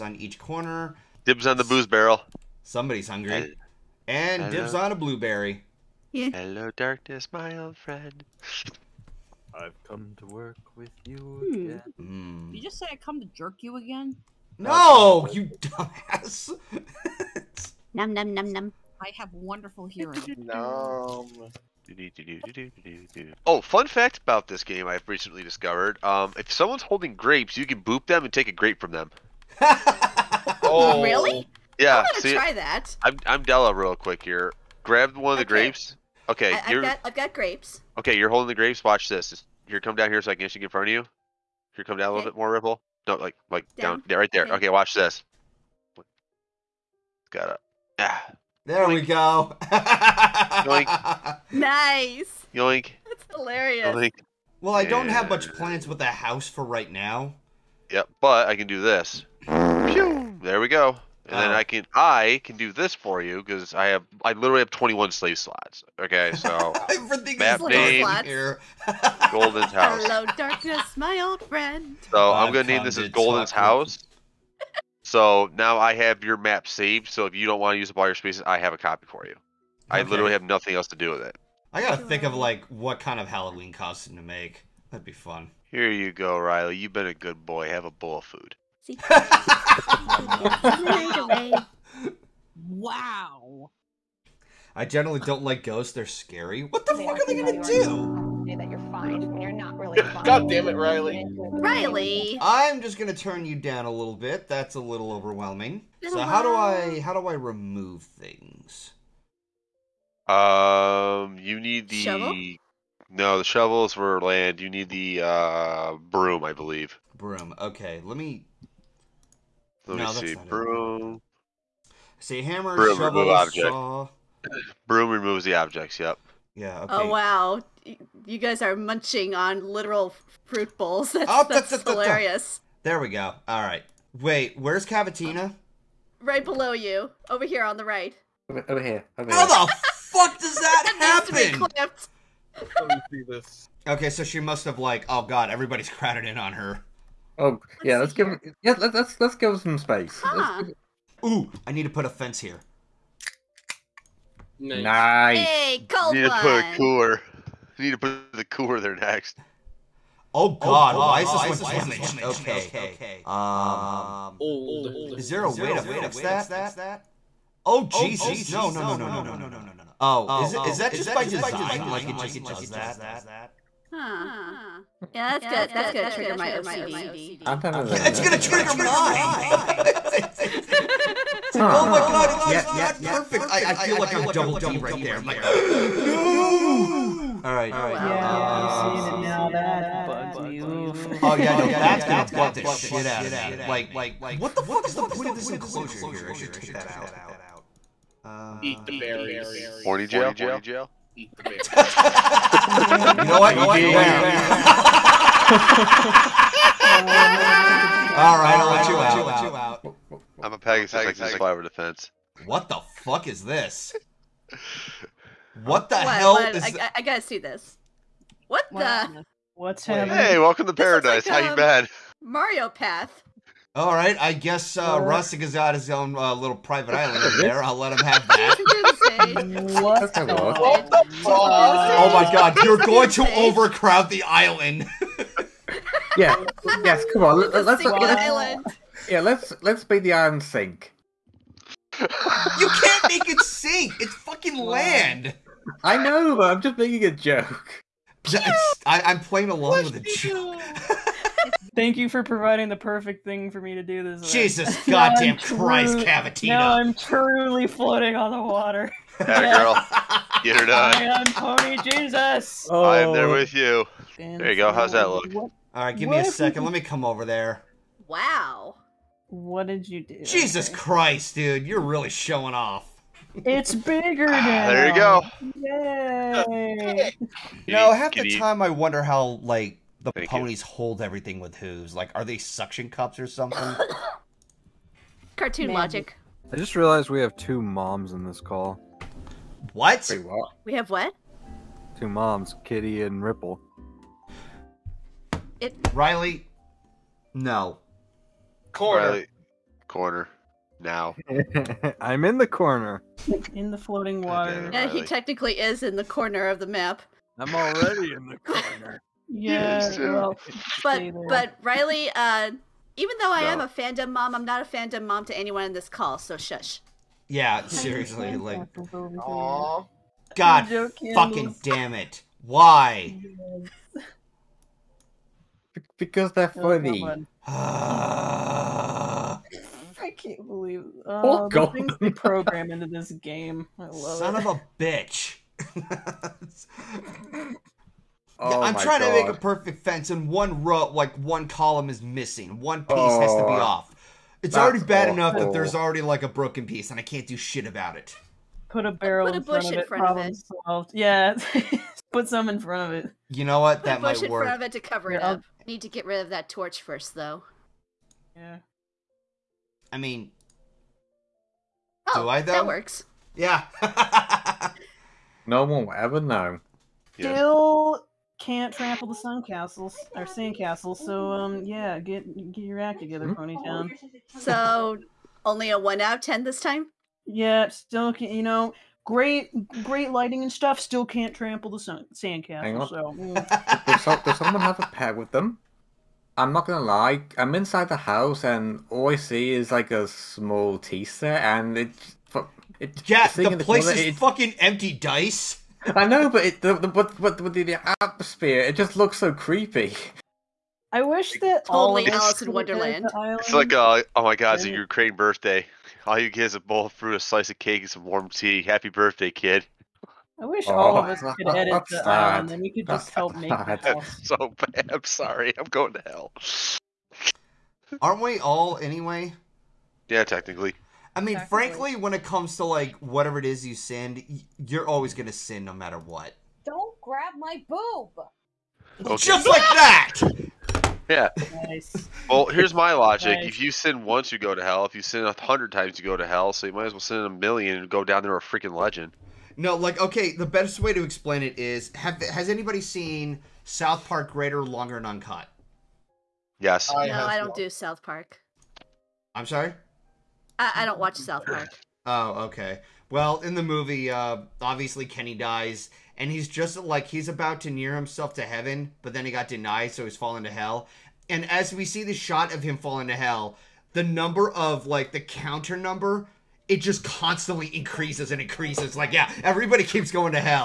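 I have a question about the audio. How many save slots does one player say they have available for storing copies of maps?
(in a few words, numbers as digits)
21.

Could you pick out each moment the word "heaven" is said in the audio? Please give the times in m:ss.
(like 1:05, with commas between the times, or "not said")
7:38.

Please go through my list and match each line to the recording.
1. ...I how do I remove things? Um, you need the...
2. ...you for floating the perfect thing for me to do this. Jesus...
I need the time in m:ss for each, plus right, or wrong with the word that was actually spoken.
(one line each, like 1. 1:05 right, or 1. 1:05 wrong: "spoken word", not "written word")
1. 1:46 right
2. 4:11 wrong: "providing", not "floating".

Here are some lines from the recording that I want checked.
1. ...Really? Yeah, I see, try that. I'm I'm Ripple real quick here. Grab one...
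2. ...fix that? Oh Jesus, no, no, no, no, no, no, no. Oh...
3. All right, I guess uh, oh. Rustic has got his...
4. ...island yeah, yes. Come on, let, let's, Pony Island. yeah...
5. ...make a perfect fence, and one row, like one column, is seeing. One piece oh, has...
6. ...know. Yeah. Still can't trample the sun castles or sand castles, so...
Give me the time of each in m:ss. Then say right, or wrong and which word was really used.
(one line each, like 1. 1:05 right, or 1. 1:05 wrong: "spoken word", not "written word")
1. 0:31 wrong: "Della", not "Ripple"
2. 2:45 right
3. 3:43 right
4. 3:54 wrong: "Sink", not "Pony"
5. 5:39 wrong: "missing", not "seeing"
6. 6:06 right.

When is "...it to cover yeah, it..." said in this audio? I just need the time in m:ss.
5:54.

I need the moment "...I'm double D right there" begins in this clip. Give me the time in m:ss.
3:04.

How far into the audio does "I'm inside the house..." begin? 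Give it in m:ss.
6:27.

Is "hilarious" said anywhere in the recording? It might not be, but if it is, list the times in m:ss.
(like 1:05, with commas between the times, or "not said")
0:53, 2:11.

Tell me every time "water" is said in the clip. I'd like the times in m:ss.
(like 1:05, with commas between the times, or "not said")
4:18, 5:04.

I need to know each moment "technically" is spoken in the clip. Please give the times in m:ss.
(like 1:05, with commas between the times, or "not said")
5:05, 7:00.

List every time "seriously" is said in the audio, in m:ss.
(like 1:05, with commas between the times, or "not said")
5:17.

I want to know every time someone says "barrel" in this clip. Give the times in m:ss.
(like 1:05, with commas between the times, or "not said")
0:01, 5:48.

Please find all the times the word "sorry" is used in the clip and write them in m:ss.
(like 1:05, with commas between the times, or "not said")
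6:55, 7:29.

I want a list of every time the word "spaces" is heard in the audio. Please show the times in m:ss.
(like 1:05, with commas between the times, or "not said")
1:18, 2:29.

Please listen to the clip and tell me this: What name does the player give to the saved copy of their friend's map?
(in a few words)
Golden's house.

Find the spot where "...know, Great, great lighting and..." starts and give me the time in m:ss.
6:18.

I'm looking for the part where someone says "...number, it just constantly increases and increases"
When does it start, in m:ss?
7:45.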